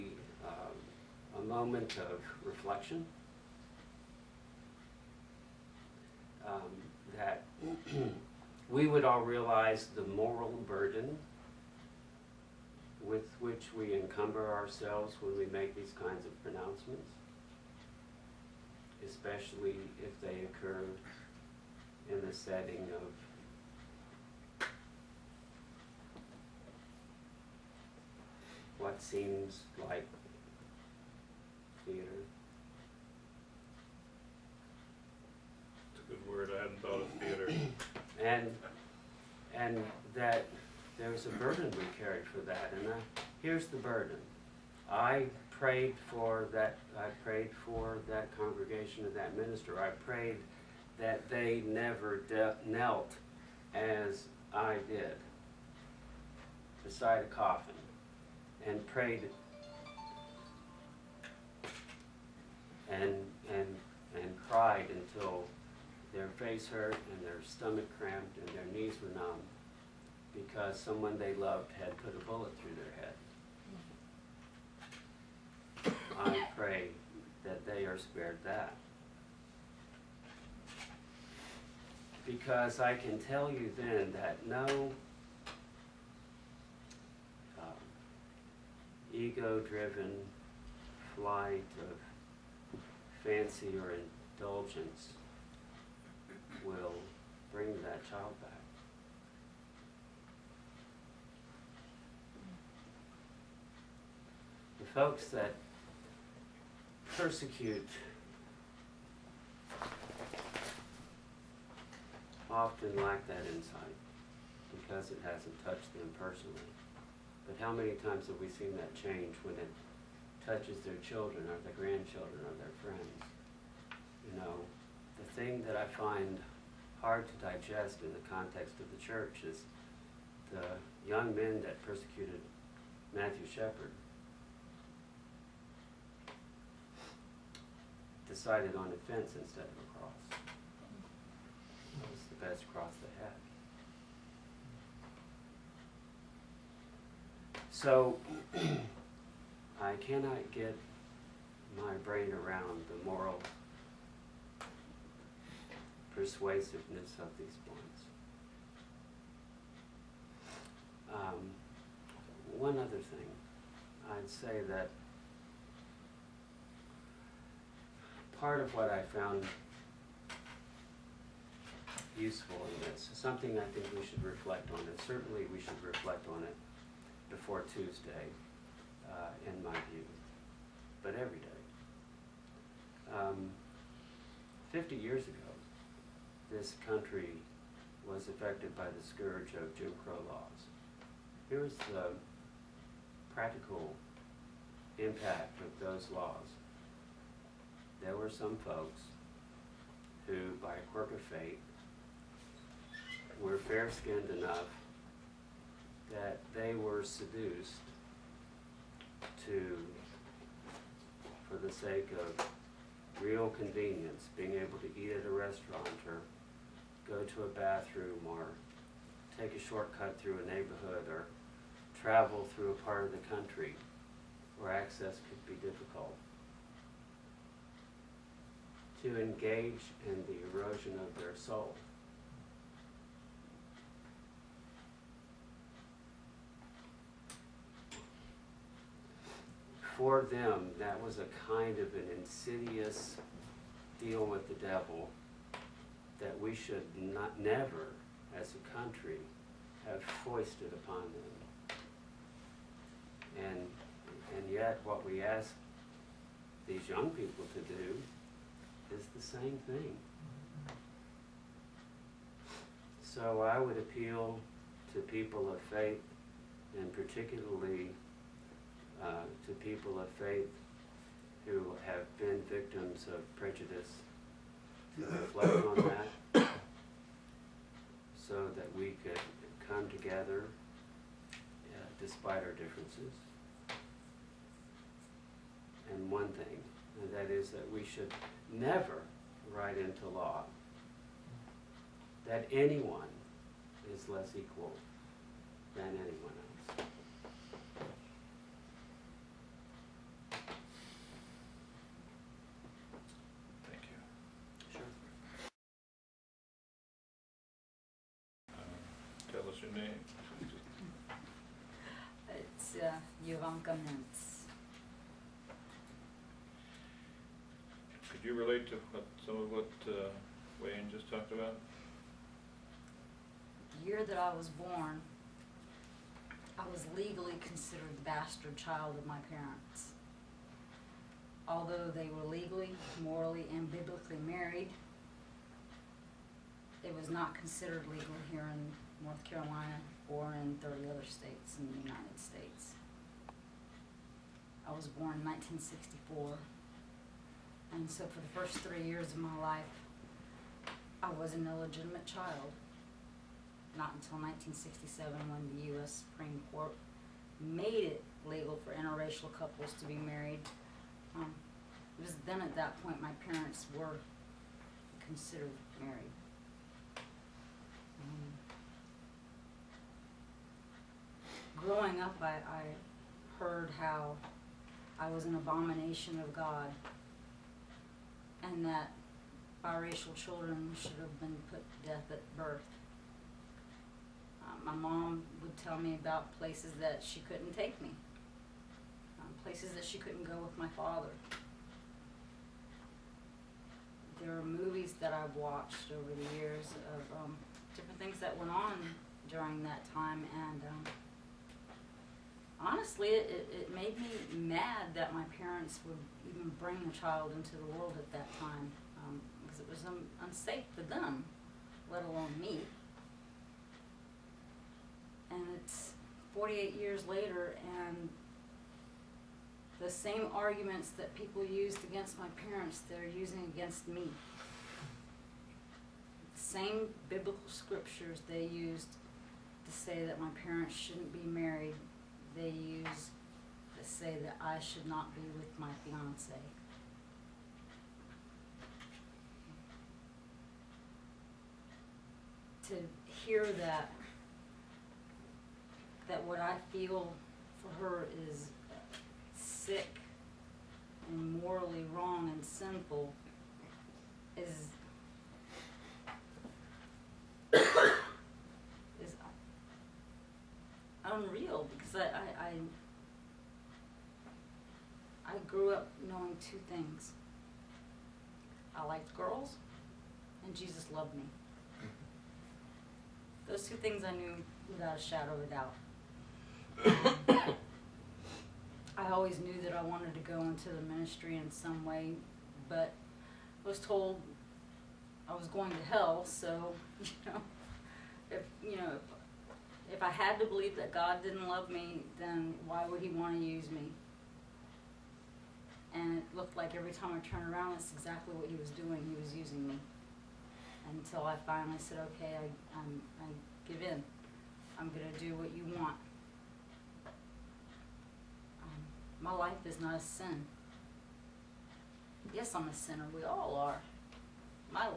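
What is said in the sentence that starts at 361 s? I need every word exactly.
Um, it was then at that point my parents were considered married.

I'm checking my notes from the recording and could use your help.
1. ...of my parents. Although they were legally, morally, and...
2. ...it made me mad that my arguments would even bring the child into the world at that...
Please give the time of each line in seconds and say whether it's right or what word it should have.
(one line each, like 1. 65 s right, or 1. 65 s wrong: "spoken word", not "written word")
1. 328 s right
2. 403 s wrong: "parents", not "arguments".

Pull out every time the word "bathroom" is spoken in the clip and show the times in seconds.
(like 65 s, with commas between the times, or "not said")
217 s.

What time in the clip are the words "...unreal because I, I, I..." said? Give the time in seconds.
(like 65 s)
461 s.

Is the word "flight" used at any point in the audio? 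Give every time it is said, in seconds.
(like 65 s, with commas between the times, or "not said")
91 s.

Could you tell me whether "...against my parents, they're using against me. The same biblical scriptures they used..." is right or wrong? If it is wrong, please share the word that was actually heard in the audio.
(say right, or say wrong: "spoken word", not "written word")
right.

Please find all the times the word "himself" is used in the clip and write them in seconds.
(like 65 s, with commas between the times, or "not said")
not said.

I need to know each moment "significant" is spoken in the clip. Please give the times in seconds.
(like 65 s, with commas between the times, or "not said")
not said.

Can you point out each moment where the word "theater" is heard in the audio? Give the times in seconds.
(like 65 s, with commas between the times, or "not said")
31 s, 37 s.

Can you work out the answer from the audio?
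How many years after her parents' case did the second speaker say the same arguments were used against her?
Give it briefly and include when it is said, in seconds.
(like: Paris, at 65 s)
48, at 416 s.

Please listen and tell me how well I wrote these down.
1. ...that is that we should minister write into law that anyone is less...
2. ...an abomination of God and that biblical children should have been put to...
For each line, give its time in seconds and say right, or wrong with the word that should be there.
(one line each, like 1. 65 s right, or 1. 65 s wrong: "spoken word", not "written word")
1. 287 s wrong: "never", not "minister"
2. 375 s wrong: "biracial", not "biblical".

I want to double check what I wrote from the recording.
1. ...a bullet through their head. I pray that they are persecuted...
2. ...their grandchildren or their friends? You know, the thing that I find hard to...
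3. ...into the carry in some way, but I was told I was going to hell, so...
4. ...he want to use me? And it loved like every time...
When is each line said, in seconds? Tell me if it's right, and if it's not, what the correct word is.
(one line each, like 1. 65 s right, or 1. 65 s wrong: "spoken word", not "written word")
1. 72 s wrong: "spared", not "persecuted"
2. 121 s right
3. 480 s wrong: "ministry", not "carry"
4. 493 s wrong: "looked", not "loved".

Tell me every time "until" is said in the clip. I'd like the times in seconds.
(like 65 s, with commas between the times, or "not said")
64 s, 353 s, 500 s.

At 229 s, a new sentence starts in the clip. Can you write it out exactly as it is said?
To engage in the erosion of their soul.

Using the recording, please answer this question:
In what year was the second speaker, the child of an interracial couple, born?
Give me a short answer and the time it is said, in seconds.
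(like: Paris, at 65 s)
1964, at 345 s.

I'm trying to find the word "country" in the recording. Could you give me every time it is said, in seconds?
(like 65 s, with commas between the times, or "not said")
186 s, 223 s, 248 s.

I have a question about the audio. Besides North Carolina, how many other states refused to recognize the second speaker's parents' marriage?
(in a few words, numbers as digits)
30.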